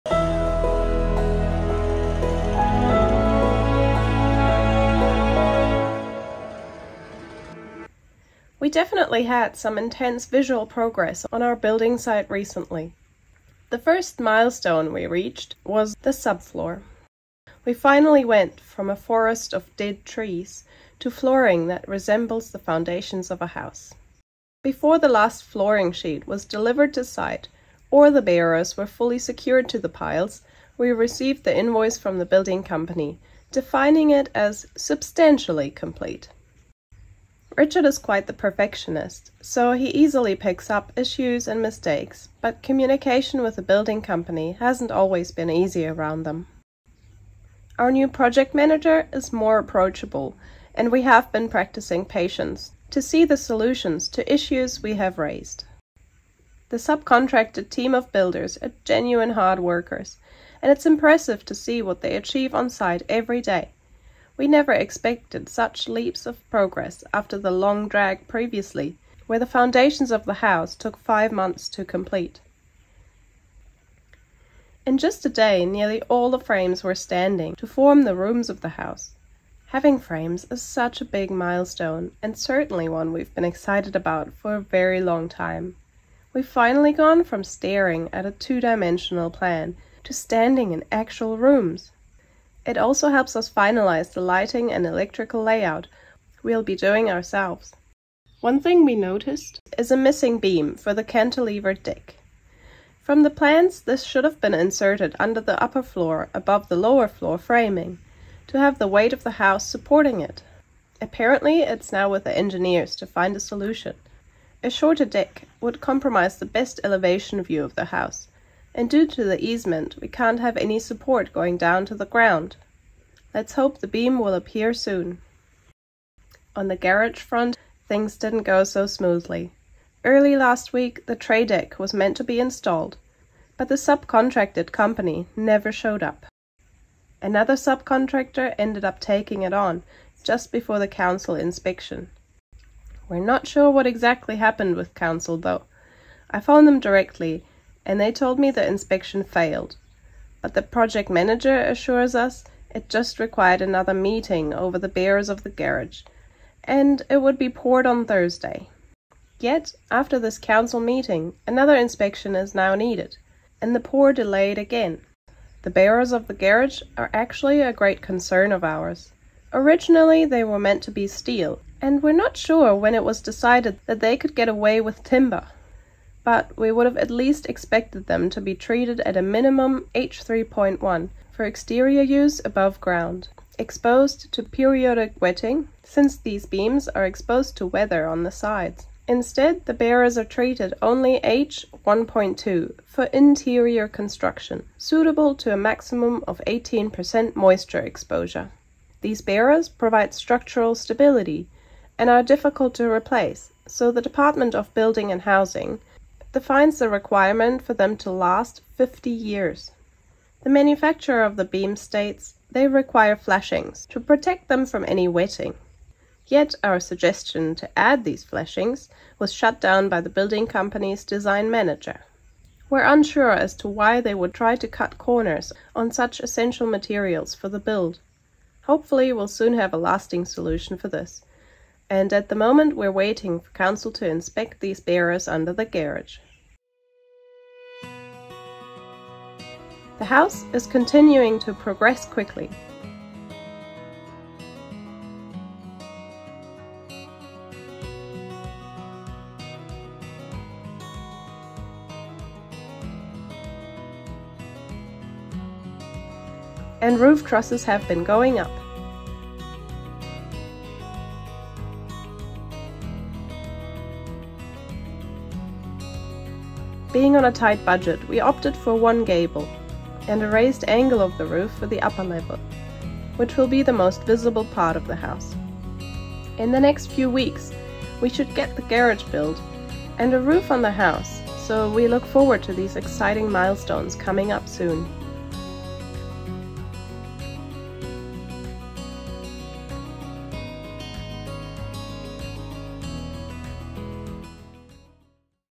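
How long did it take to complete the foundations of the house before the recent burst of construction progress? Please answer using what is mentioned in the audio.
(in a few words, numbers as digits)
5 months.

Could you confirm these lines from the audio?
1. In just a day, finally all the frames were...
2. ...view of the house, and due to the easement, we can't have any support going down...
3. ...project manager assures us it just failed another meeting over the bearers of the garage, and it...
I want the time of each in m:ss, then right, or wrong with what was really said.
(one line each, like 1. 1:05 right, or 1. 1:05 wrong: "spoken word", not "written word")
1. 1:14 wrong: "nearly", not "finally"
2. 1:57 right
3. 2:30 wrong: "required", not "failed".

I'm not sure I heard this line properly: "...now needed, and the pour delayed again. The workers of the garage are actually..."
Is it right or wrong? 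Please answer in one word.
wrong.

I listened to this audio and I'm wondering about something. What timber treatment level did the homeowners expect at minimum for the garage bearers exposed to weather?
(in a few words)
H3.1.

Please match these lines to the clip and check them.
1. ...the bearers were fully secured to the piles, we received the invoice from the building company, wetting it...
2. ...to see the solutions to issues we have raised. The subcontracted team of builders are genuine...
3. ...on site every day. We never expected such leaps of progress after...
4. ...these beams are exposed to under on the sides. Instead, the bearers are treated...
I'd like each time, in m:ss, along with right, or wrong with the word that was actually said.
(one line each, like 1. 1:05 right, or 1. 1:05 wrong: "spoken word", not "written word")
1. 0:28 wrong: "defining", not "wetting"
2. 0:52 right
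3. 1:02 right
4. 3:06 wrong: "weather", not "under".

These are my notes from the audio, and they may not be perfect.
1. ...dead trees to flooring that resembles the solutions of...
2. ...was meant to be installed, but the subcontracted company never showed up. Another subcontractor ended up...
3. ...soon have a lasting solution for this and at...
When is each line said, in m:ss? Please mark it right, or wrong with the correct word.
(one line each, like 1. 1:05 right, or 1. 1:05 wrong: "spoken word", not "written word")
1. 0:19 wrong: "foundations", not "solutions"
2. 2:11 right
3. 3:49 right.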